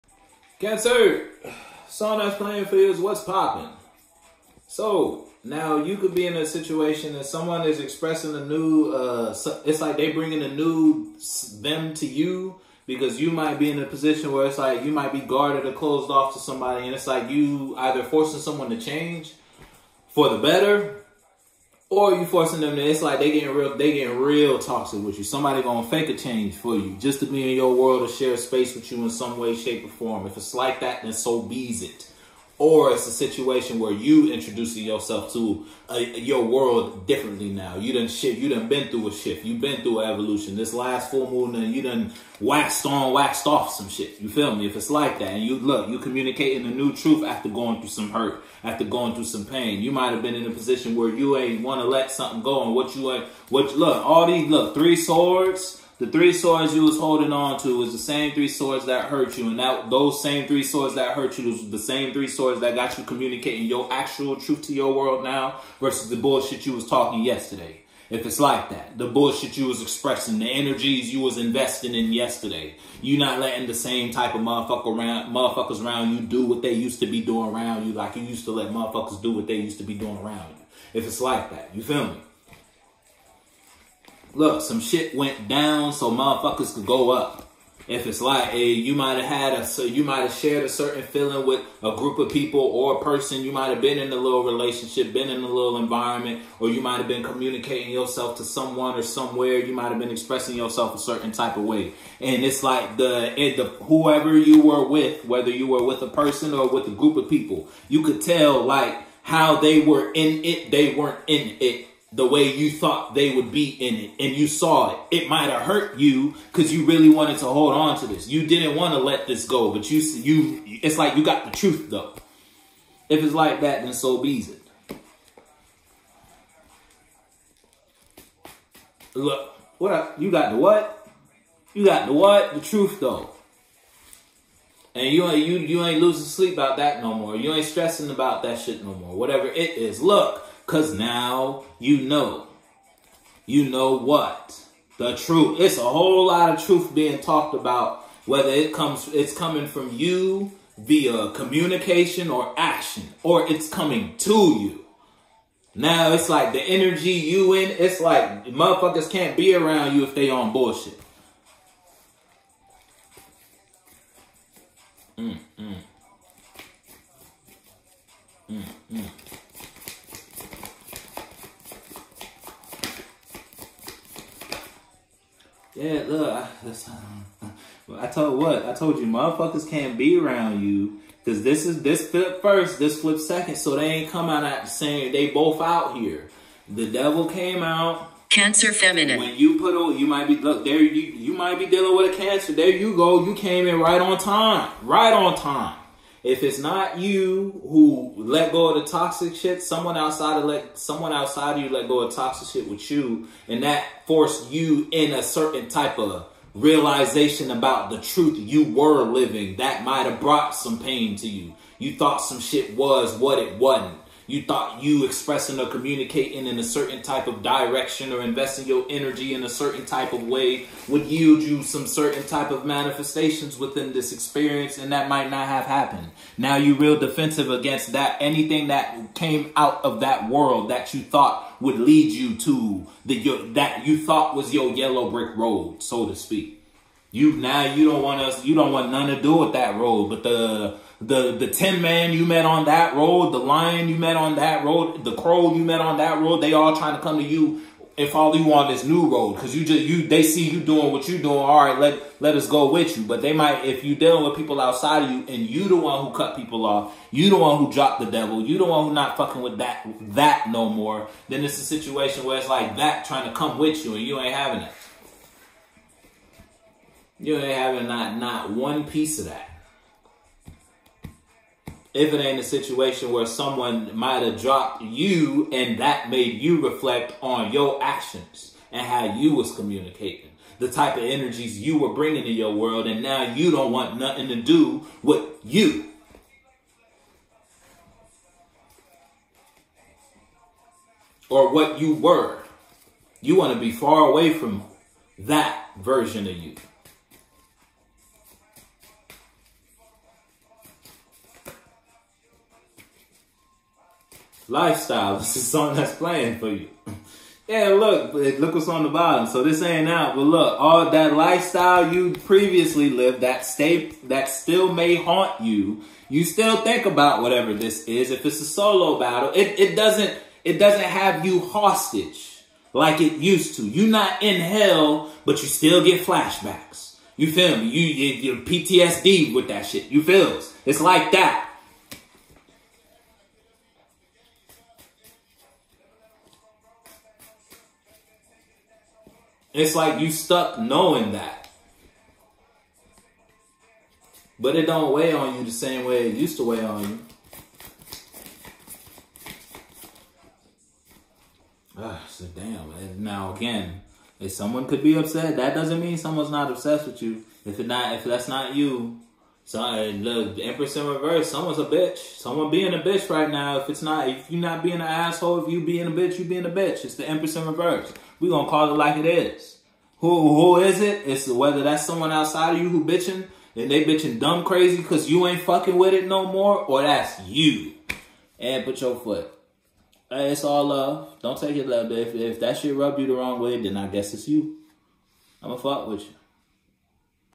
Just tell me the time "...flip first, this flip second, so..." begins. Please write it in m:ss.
3:02.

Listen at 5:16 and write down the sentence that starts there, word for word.
You still think about whatever this is.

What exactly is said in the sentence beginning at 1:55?
It might have hurt you because you really wanted to hold on to this.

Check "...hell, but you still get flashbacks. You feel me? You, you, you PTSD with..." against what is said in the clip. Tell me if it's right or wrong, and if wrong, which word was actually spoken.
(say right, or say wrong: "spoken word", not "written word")
right.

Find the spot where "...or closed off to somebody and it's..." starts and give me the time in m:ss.
0:15.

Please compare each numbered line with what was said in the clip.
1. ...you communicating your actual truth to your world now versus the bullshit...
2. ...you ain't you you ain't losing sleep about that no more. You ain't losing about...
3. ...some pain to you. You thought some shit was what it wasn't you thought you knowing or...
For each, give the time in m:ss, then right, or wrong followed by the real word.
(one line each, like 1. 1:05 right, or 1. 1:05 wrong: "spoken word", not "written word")
1. 1:02 right
2. 2:15 wrong: "stressing", not "losing"
3. 3:30 wrong: "expressing", not "knowing".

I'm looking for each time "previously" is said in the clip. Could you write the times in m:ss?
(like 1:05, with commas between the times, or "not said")
5:12.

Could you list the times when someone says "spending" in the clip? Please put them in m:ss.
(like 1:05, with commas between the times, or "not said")
not said.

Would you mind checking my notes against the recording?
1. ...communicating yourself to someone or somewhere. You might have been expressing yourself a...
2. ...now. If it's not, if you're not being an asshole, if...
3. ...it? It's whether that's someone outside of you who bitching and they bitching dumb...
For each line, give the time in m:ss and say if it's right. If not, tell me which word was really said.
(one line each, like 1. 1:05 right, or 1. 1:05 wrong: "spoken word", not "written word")
1. 1:37 right
2. 6:03 right
3. 6:10 right.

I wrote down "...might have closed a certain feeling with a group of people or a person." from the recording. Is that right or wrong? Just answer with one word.
wrong.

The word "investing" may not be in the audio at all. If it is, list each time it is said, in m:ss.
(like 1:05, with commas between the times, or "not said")
1:11, 3:38.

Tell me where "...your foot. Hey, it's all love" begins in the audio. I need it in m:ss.
6:18.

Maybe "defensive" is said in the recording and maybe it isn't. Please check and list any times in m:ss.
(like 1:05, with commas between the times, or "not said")
3:46.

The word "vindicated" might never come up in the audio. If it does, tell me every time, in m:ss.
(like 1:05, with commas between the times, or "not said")
not said.